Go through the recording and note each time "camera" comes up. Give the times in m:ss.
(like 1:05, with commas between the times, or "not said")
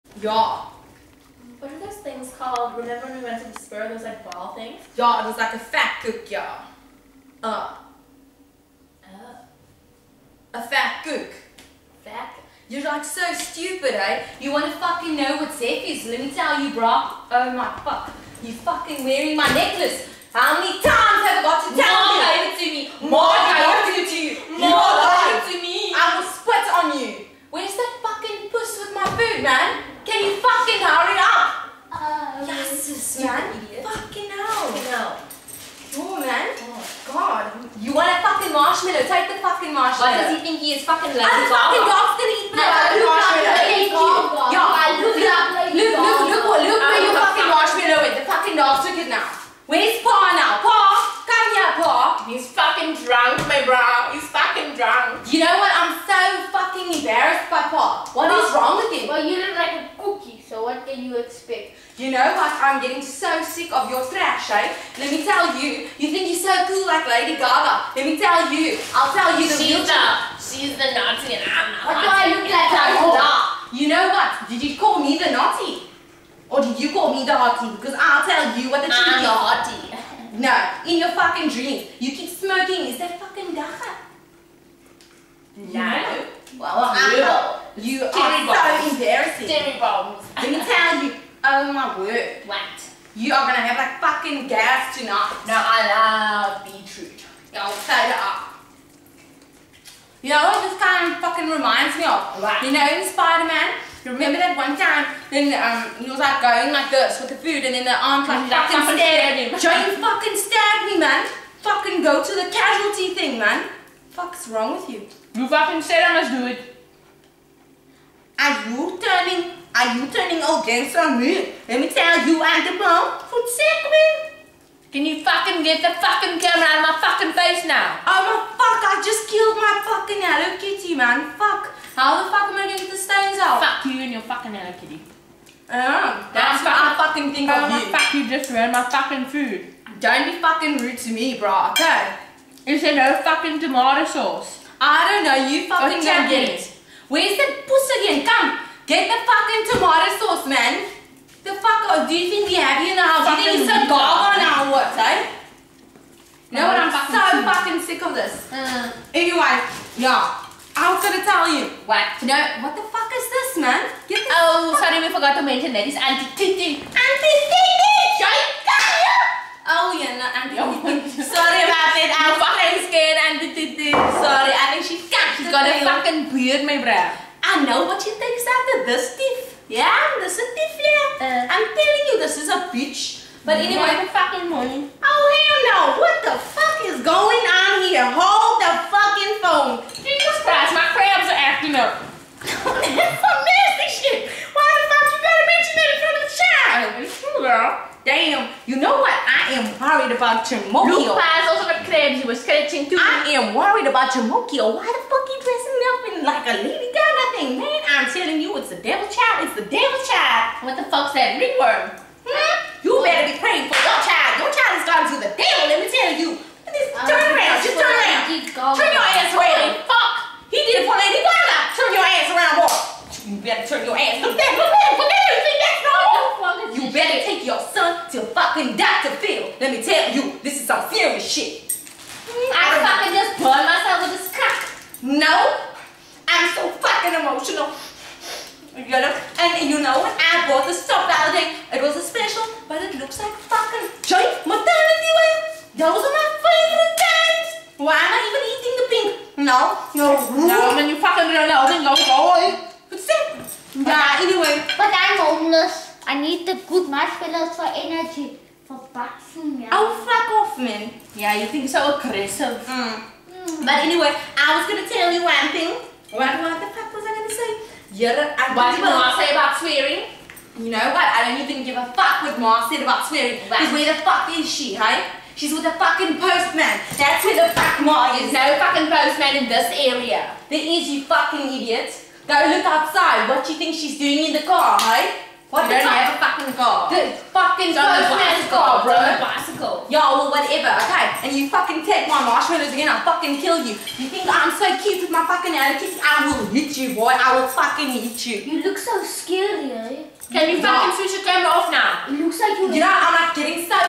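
2:06, 5:01.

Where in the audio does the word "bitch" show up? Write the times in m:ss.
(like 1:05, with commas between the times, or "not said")
3:02.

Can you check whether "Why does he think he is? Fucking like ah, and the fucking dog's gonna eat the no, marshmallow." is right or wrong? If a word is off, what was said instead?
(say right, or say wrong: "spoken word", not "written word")
right.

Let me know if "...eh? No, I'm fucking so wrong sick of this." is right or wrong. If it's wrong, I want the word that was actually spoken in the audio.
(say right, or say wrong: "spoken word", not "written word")
wrong: "fucking", not "wrong".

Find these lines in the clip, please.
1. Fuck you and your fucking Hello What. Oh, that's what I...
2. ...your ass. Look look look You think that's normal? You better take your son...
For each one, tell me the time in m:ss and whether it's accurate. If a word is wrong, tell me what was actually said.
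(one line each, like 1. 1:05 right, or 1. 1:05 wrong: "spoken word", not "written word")
1. 2:13 wrong: "Kitty", not "What"
2. 3:43 right.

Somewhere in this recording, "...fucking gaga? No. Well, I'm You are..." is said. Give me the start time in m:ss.
1:23.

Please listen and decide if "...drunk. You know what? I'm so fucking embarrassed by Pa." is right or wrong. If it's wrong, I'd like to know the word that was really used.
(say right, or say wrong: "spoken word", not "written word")
right.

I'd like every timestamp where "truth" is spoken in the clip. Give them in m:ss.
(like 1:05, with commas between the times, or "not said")
1:18, 1:37.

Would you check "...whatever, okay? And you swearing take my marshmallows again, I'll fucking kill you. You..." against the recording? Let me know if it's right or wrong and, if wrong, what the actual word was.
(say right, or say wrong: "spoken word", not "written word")
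wrong: "fucking", not "swearing".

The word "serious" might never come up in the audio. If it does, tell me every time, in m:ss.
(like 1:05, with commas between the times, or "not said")
3:50.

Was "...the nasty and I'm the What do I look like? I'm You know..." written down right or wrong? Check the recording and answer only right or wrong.
wrong.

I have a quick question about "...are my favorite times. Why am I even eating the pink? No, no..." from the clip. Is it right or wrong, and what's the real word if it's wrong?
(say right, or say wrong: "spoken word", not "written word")
right.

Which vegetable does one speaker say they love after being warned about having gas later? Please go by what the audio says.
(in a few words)
Beetroot.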